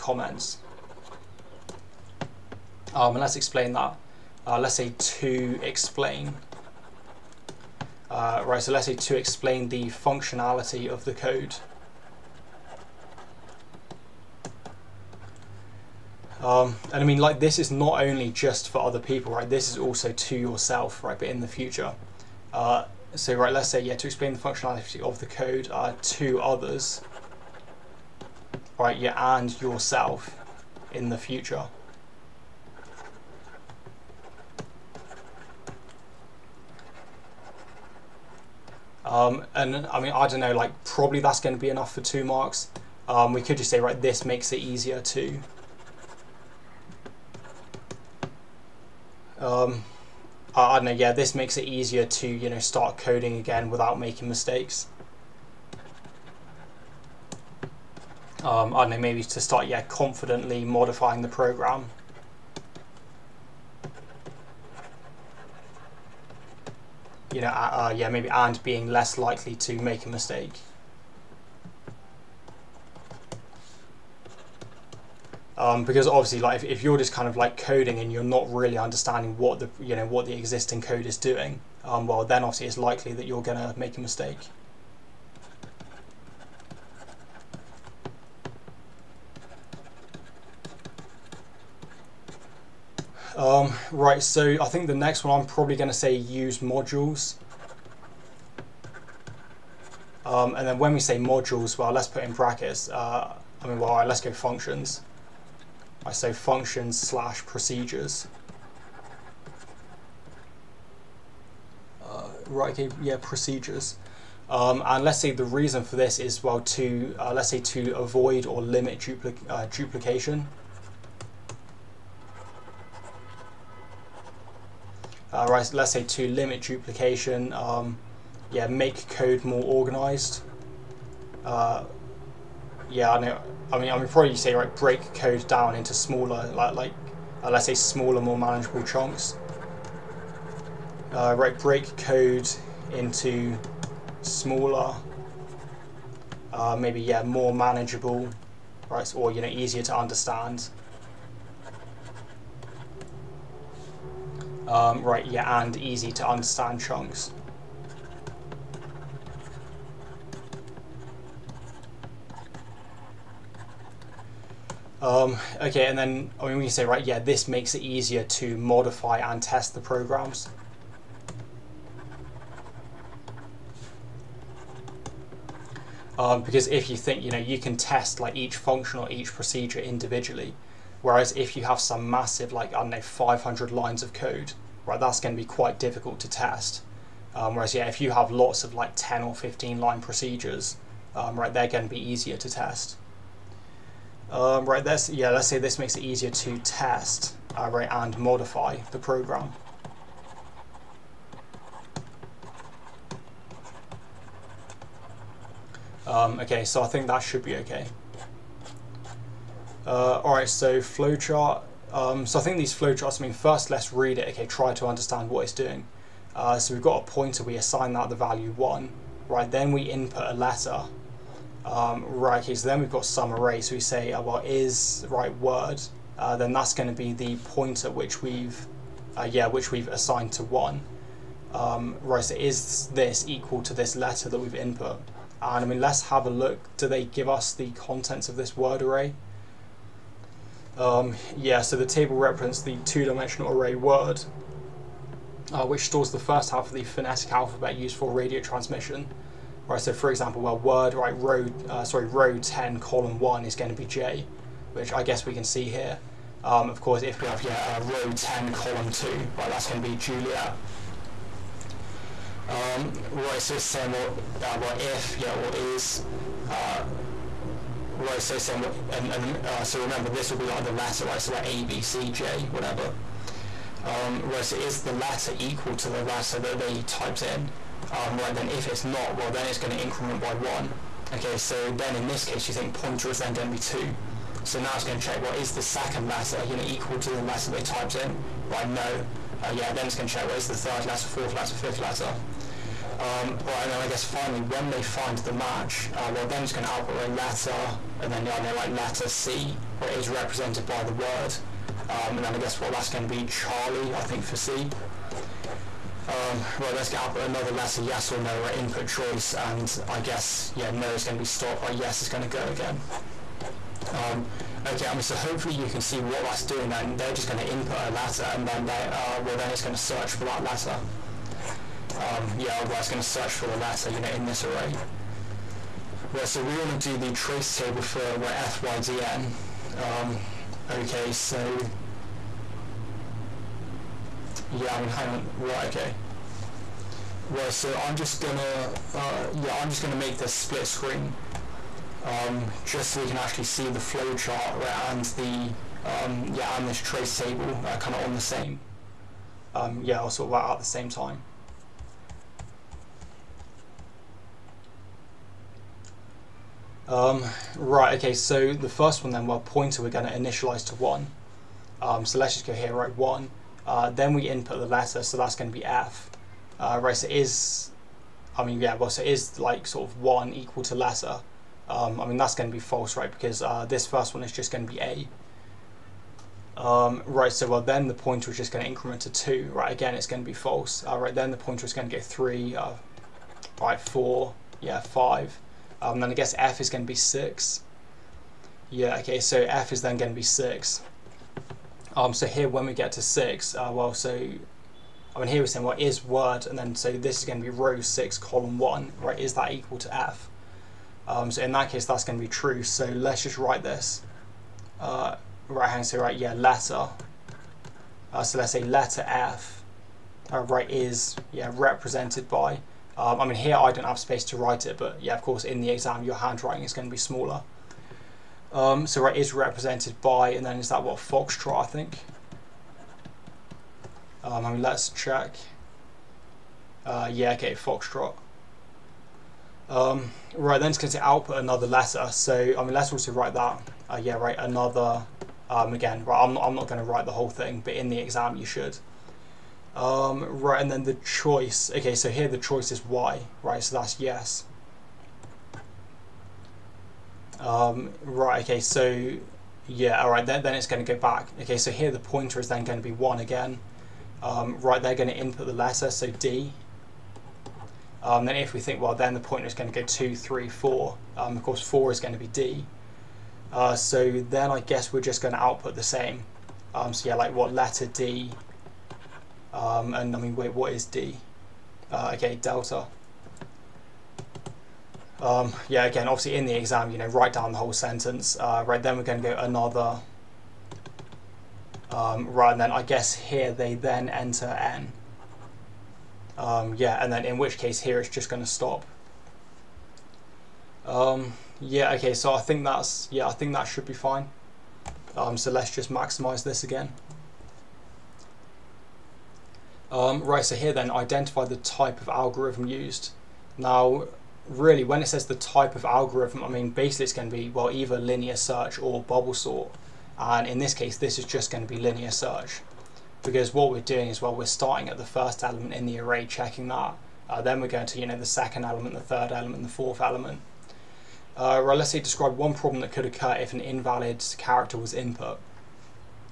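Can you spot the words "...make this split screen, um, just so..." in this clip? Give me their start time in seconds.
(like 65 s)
339 s.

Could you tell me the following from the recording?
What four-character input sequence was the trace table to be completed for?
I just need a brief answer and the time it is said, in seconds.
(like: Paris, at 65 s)
FYDN, at 328 s.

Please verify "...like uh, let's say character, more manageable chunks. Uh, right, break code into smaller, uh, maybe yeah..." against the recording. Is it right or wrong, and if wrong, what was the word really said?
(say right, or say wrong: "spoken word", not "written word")
wrong: "smaller", not "character".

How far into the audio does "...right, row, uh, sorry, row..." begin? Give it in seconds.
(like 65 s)
250 s.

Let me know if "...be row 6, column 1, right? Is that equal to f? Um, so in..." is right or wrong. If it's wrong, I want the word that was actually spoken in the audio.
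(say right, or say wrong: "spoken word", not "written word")
right.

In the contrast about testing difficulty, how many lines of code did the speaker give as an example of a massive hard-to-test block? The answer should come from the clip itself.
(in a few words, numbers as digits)
500.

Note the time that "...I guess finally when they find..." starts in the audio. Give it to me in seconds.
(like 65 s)
293 s.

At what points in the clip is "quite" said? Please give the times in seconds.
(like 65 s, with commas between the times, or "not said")
185 s.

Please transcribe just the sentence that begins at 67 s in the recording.
you know, uh, uh, yeah, maybe and being less likely to make a mistake.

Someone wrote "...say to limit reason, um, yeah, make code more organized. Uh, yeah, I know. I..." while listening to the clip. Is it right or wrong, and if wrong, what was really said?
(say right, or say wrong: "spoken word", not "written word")
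wrong: "duplication", not "reason".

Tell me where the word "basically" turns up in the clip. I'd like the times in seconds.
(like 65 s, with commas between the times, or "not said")
506 s.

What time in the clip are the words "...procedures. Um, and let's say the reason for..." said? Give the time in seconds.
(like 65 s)
113 s.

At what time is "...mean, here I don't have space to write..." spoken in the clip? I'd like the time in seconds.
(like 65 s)
413 s.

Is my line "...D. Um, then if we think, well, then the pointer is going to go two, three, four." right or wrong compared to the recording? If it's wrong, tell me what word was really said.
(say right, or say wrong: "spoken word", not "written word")
right.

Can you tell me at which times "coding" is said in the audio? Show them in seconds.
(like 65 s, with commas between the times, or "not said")
52 s, 77 s.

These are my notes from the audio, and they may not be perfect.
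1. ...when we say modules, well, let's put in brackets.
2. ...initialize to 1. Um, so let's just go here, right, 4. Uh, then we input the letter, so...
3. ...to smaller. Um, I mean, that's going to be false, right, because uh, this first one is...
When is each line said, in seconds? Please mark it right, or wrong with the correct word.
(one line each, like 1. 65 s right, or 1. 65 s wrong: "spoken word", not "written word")
1. 100 s right
2. 360 s wrong: "1", not "4"
3. 370 s wrong: "letter", not "smaller".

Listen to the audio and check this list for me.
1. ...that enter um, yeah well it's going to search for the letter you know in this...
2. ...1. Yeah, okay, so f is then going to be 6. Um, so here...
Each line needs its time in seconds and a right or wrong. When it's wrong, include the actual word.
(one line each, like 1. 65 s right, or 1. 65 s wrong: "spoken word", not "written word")
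1. 320 s wrong: "letter", not "enter"
2. 386 s wrong: "6", not "1".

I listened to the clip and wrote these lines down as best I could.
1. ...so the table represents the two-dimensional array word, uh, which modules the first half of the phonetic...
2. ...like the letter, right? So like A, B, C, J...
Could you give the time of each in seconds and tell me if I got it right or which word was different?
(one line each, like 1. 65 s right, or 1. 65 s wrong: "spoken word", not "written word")
1. 241 s wrong: "stores", not "modules"
2. 270 s right.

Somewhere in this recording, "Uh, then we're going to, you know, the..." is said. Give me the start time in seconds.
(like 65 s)
517 s.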